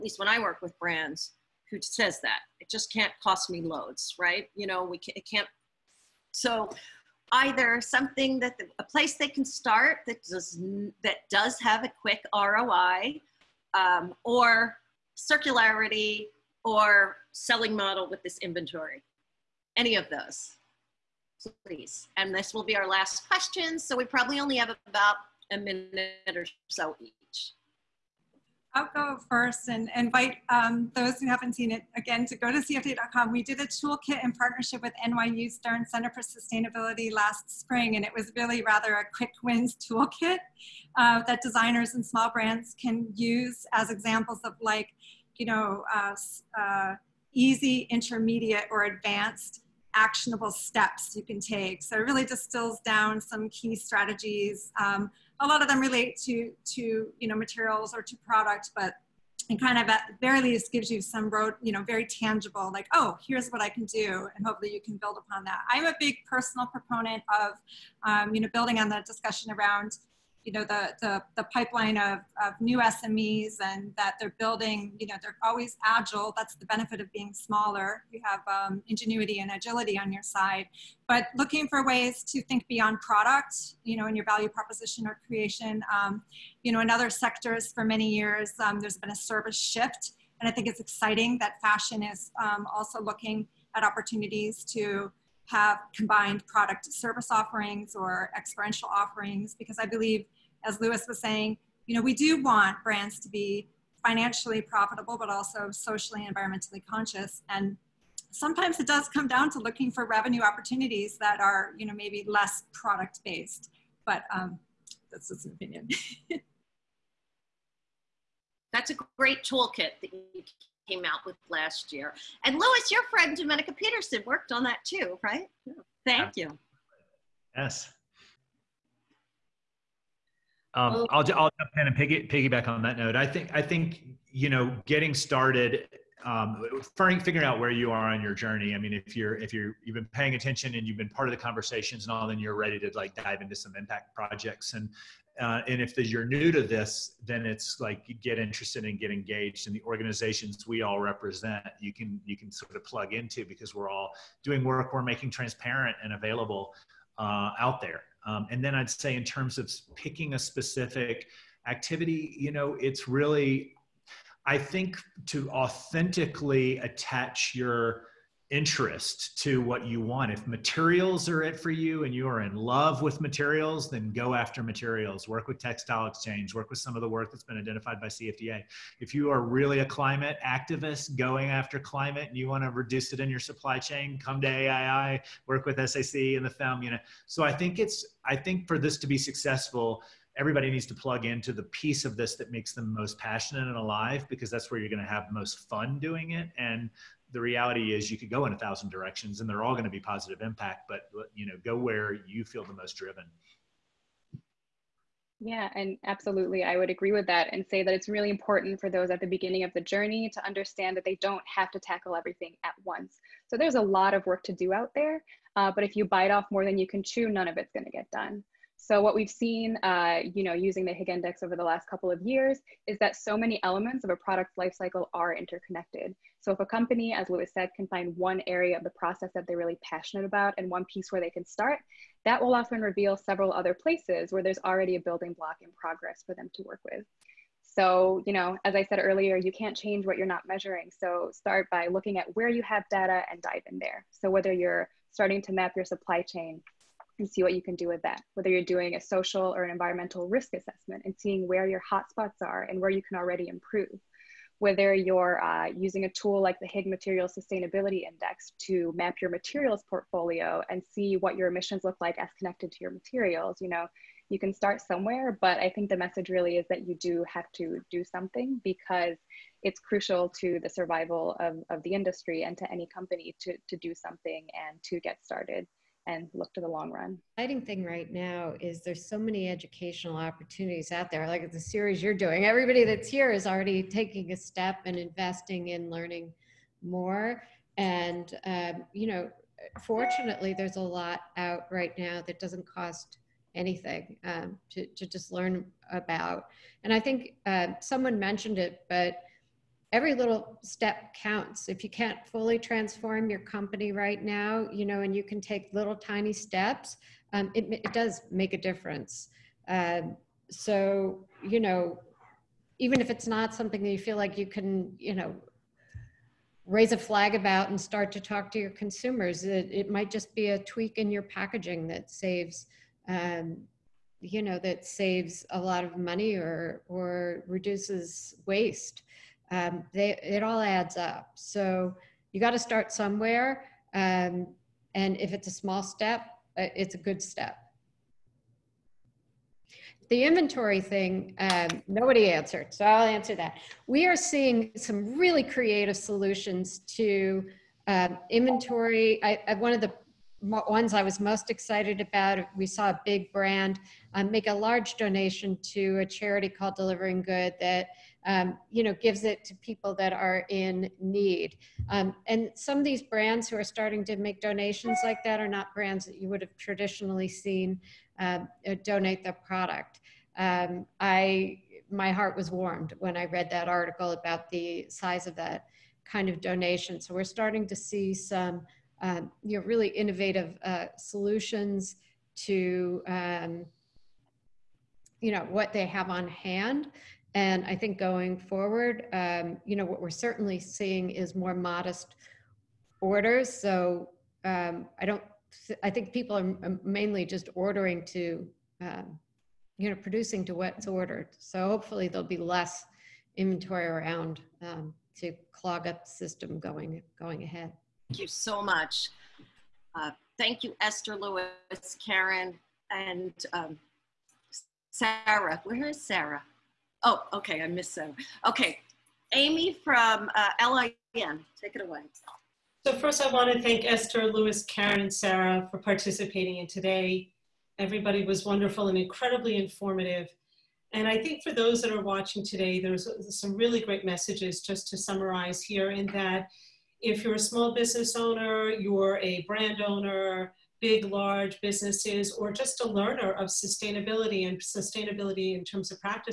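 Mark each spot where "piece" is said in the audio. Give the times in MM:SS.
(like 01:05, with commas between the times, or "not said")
03:11, 03:50.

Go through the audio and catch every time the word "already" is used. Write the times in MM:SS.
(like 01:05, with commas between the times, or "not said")
03:54, 04:13, 04:43.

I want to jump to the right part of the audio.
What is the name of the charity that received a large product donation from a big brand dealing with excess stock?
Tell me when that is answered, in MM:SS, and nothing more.
05:56.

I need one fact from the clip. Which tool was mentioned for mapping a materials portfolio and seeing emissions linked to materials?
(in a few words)
Higg Material Sustainability Index.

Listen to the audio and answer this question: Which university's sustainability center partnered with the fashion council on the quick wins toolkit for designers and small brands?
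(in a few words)
NYU Stern.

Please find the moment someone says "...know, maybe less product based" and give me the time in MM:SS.
01:51.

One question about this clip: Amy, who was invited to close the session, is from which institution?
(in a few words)
LIM.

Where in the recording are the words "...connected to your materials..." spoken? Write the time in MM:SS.
04:22.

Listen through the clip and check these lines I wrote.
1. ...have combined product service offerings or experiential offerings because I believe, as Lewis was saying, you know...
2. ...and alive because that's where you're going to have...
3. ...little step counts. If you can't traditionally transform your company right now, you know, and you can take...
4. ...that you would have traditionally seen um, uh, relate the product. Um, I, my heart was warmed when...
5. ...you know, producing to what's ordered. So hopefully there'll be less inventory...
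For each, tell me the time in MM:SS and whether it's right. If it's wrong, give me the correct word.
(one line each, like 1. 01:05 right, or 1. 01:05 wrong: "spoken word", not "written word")
1. 01:35 right
2. 03:13 right
3. 05:00 wrong: "fully", not "traditionally"
4. 06:06 wrong: "donate", not "relate"
5. 06:39 right.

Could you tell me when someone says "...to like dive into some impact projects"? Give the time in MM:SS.
02:22.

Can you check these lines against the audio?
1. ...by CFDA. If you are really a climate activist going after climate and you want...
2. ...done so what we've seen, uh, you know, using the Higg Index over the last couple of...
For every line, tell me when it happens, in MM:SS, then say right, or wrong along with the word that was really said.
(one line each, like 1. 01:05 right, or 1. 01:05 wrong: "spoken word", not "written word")
1. 02:57 right
2. 03:38 right.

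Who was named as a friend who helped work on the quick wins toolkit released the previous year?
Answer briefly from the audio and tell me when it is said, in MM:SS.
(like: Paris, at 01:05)
Domenica Peterson, at 02:03.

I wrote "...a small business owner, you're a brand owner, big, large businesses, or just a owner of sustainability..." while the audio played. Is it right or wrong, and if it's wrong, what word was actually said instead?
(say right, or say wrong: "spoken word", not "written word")
wrong: "learner", not "owner".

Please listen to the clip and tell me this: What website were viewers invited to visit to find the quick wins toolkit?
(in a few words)
CFDA.com.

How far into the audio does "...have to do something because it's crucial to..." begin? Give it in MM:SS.
04:27.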